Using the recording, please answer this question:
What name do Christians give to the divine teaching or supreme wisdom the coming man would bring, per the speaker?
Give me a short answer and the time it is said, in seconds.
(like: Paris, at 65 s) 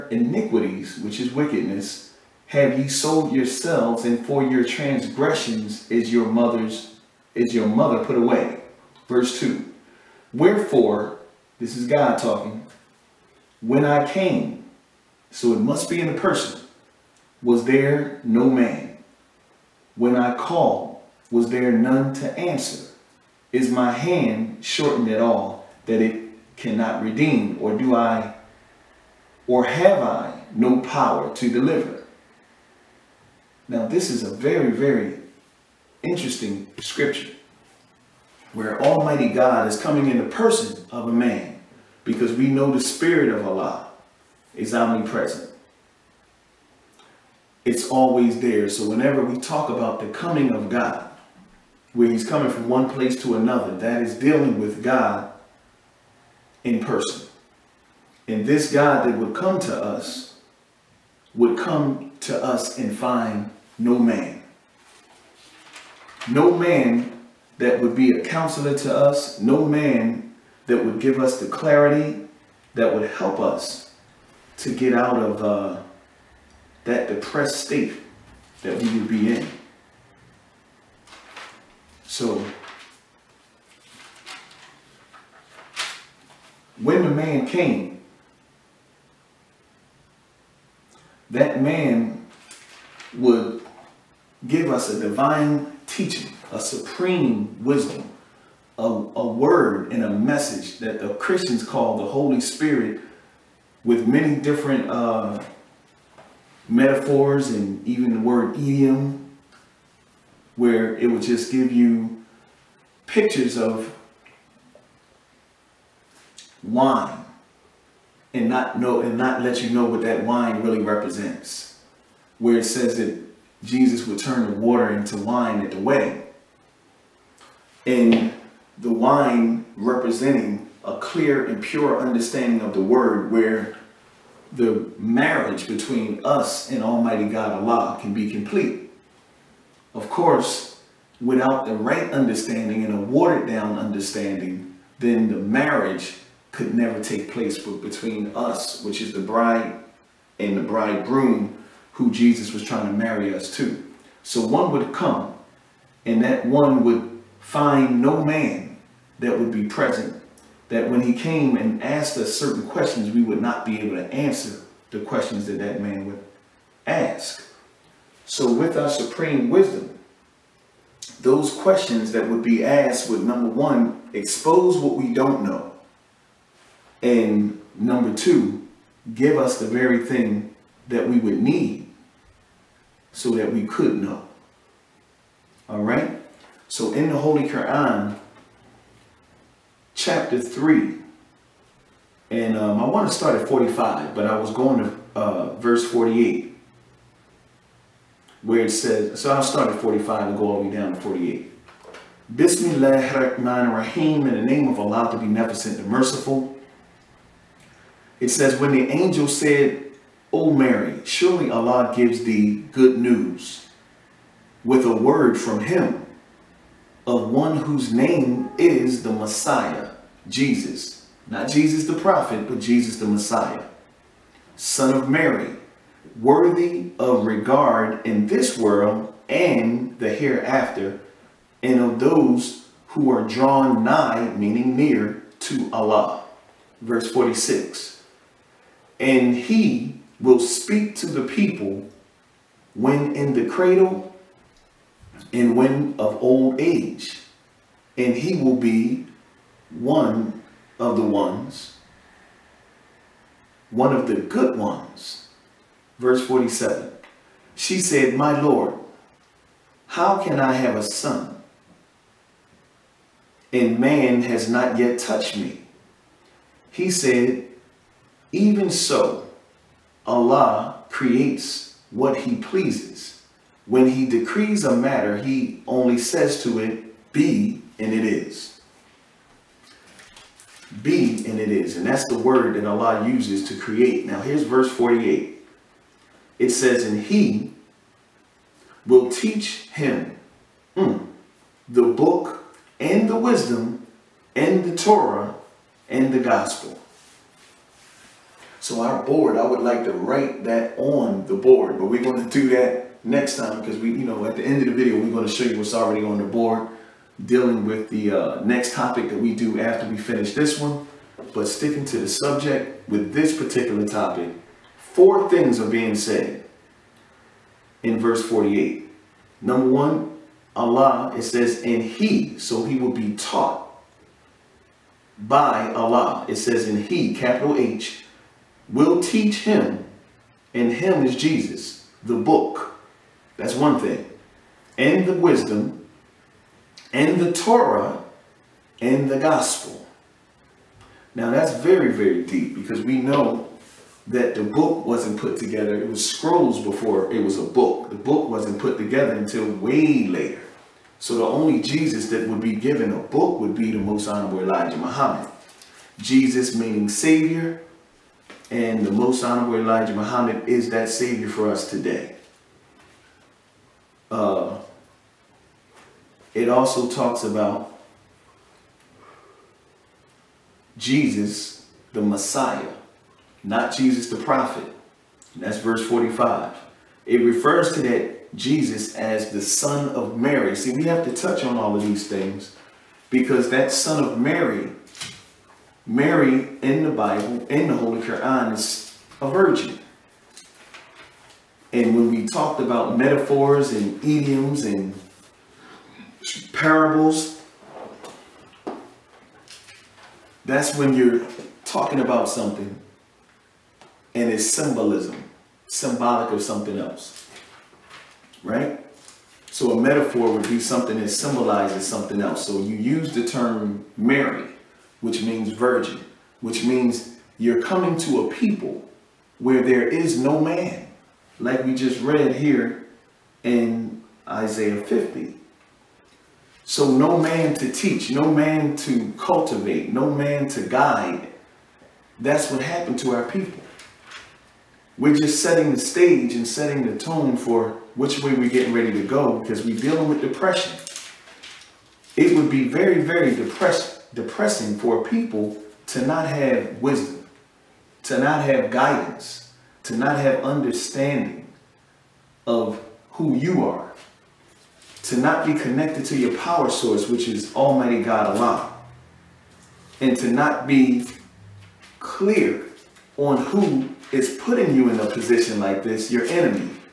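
The Holy Spirit, at 101 s.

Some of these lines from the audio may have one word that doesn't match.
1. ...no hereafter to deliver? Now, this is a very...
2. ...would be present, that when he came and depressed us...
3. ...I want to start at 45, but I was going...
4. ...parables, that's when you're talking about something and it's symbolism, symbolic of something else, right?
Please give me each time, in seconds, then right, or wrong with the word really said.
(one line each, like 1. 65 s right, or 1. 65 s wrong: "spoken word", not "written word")
1. 30 s wrong: "power", not "hereafter"
2. 159 s wrong: "asked", not "depressed"
3. 192 s right
4. 396 s right.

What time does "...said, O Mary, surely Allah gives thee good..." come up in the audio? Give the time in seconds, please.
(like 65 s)
209 s.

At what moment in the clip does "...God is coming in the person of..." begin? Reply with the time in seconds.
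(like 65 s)
39 s.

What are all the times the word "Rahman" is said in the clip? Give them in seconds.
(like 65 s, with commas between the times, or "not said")
203 s.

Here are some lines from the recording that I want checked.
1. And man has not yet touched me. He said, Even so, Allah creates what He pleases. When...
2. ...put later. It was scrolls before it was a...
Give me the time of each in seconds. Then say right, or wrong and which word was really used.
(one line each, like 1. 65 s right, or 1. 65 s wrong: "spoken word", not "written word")
1. 263 s right
2. 345 s wrong: "together", not "later".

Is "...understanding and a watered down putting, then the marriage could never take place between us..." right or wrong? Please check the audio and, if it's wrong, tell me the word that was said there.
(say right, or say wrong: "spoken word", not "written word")
wrong: "understanding", not "putting".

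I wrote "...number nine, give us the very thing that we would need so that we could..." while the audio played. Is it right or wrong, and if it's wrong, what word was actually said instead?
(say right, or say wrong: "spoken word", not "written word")
wrong: "two", not "nine".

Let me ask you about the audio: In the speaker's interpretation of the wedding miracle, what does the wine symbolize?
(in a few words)
A clear and pure understanding of the word.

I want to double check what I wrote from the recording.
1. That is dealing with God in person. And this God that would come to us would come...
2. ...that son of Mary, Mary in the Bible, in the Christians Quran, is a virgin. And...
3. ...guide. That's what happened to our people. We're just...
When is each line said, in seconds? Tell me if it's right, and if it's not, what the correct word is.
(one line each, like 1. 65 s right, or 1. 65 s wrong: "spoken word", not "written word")
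1. 53 s right
2. 383 s wrong: "Holy", not "Christians"
3. 430 s right.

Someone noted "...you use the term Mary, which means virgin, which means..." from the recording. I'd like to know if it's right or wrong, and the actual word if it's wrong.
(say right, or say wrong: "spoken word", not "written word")
right.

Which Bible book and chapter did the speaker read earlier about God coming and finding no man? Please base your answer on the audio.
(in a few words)
Isaiah 50.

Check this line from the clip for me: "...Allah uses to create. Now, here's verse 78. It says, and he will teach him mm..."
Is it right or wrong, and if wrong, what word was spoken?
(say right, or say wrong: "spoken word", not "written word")
wrong: "48", not "78".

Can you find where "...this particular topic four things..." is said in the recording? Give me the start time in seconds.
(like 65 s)
313 s.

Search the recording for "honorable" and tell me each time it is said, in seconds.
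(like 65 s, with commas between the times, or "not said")
354 s, 359 s.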